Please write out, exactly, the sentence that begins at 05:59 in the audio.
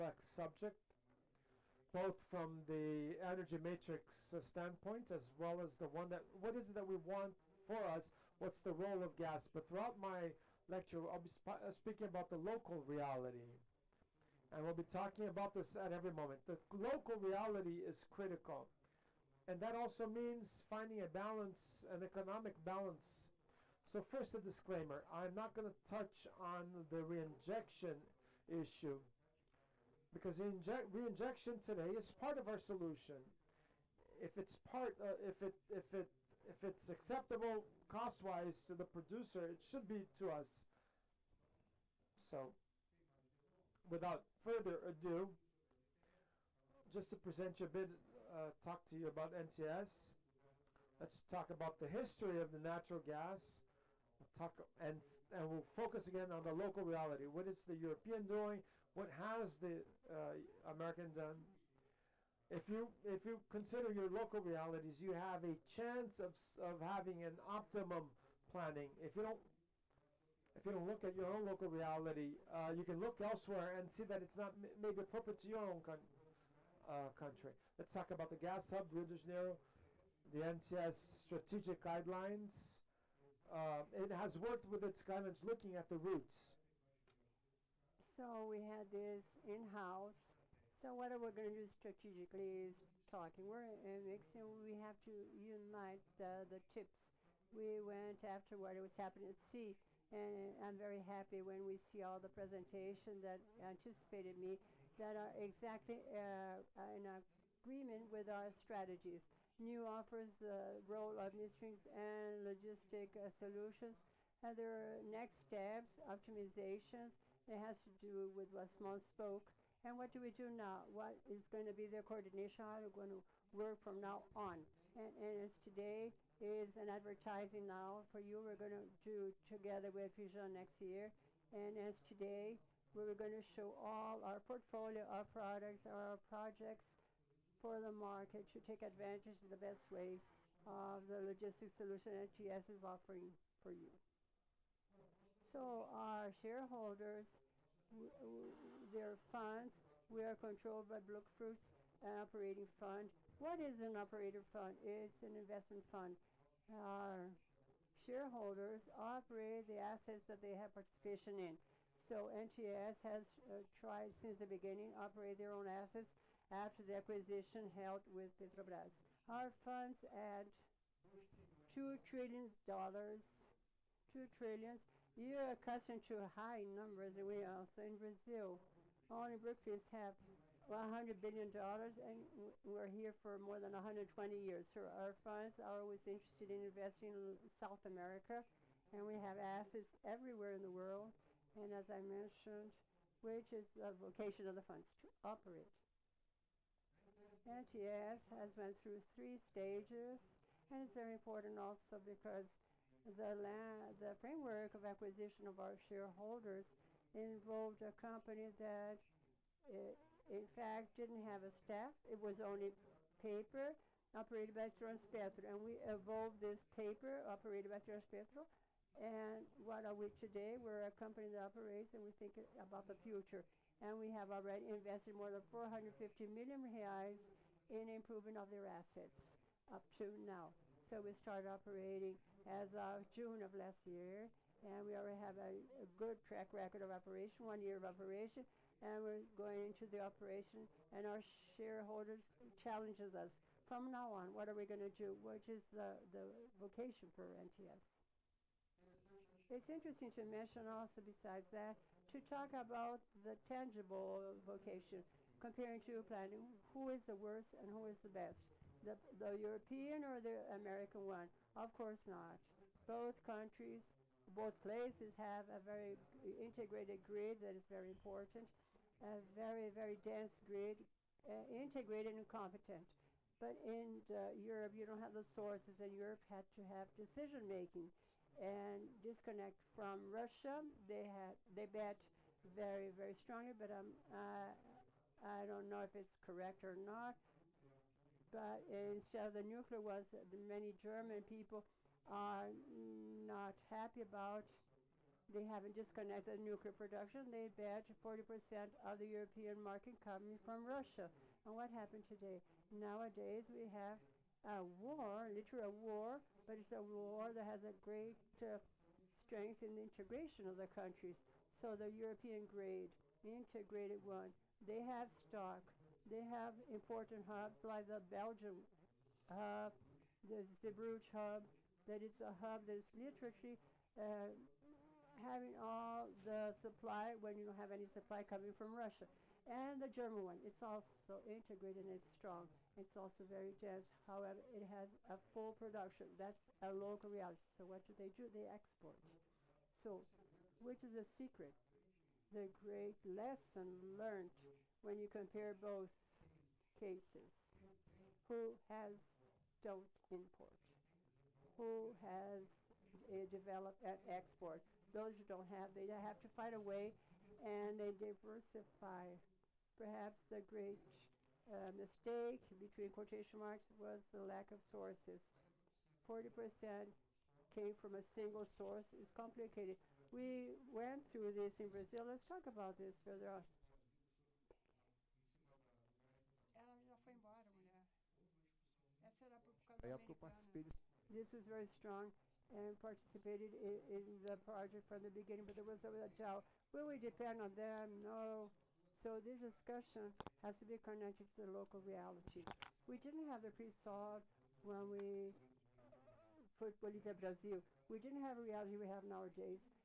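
Perhaps the great uh, mistake between quotation marks was the lack of sources.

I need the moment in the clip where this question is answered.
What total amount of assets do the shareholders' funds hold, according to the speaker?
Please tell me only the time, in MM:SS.
02:51.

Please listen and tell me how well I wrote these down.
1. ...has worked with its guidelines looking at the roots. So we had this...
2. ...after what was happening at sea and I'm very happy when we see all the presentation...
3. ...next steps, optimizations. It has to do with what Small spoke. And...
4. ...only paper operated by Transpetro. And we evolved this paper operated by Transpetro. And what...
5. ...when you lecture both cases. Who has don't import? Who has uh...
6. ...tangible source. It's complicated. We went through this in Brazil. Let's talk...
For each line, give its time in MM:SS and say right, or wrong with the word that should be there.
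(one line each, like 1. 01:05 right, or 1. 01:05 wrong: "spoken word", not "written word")
1. 01:24 right
2. 01:38 right
3. 01:55 right
4. 03:32 right
5. 05:44 wrong: "compare", not "lecture"
6. 06:08 wrong: "single", not "tangible".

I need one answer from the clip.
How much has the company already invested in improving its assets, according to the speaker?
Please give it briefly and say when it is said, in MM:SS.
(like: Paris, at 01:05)
more than 450 million reais, at 03:45.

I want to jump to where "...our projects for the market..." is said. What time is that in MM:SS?
02:15.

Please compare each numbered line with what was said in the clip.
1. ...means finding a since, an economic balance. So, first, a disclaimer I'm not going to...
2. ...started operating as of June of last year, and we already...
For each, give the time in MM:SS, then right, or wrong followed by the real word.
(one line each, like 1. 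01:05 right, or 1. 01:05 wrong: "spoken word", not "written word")
1. 00:20 wrong: "balance", not "since"
2. 03:51 right.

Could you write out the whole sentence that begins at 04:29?
A very, very dense grid, uh, integrated and competent.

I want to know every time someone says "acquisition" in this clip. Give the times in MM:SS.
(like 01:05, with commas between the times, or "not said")
02:46, 03:24.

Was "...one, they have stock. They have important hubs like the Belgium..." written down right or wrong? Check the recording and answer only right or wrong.
right.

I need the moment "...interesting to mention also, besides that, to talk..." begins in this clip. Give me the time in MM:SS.
04:09.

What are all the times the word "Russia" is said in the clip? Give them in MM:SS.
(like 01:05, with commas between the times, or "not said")
04:40, 05:00, 05:28.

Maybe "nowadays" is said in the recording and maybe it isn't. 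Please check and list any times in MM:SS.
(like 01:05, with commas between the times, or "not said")
05:02, 06:39.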